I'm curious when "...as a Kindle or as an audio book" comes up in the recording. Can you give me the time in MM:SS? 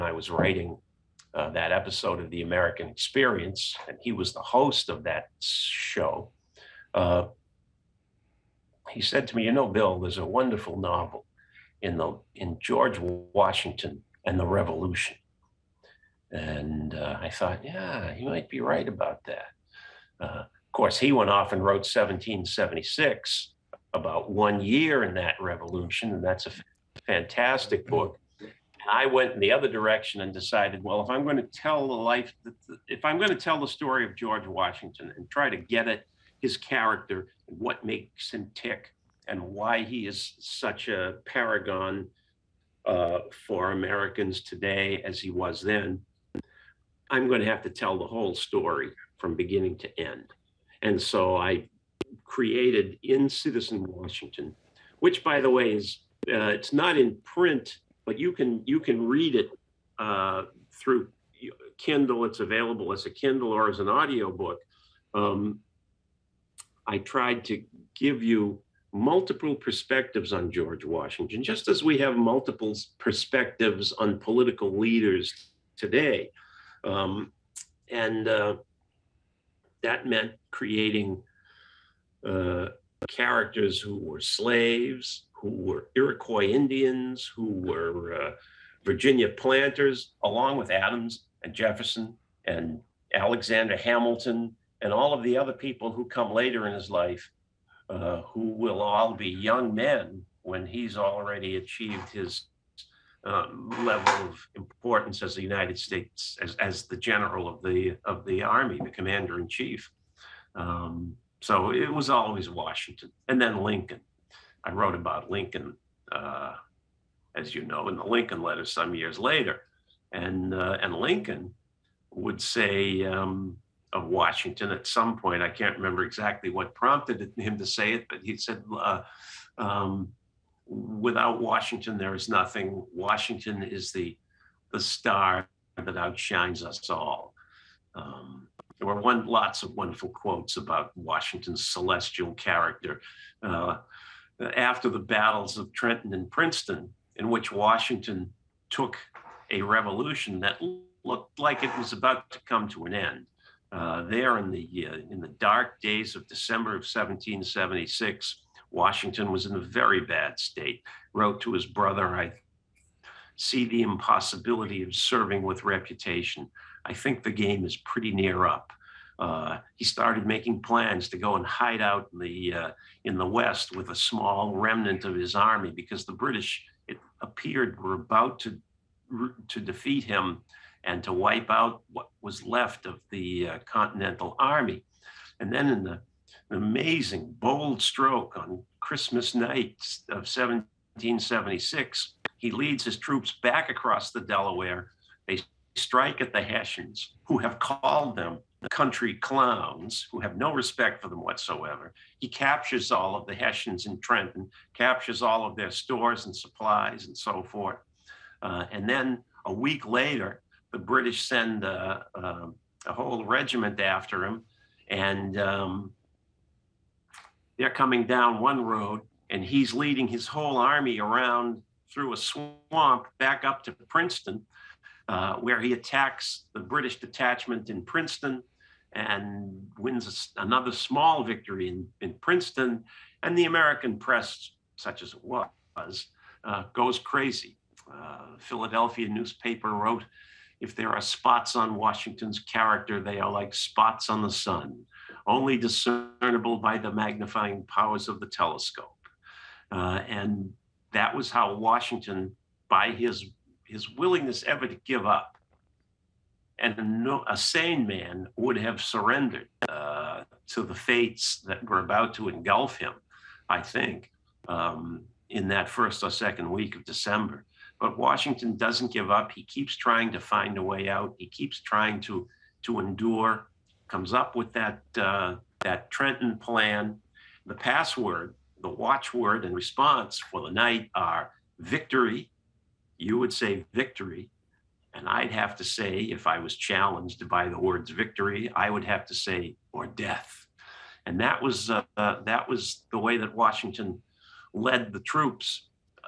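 01:02.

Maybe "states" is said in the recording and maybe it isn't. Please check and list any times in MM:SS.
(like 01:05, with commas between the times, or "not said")
01:45, 02:40.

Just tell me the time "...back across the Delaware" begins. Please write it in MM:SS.
03:13.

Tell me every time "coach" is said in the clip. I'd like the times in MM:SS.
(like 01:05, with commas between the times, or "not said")
not said.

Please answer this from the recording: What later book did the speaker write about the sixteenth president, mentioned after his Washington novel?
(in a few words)
The Lincoln Letter.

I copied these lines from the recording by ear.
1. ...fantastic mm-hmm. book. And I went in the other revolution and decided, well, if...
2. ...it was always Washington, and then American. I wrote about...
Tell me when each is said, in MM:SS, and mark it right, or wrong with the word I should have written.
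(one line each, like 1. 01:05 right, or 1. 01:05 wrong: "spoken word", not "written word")
1. 00:27 wrong: "direction", not "revolution"
2. 01:51 wrong: "Lincoln", not "American".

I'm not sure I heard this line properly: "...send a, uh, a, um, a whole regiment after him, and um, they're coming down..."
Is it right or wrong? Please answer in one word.
right.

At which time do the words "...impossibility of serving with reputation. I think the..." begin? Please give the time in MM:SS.
02:43.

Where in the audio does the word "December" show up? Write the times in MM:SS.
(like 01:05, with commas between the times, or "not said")
02:36, 04:26.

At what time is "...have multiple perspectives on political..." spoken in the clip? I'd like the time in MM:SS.
01:11.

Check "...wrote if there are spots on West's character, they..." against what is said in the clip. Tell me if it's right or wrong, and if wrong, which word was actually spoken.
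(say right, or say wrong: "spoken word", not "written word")
wrong: "Washington", not "West".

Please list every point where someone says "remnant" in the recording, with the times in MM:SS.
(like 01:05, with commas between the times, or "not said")
02:54.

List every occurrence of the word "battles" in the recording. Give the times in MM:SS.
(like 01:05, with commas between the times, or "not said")
02:24.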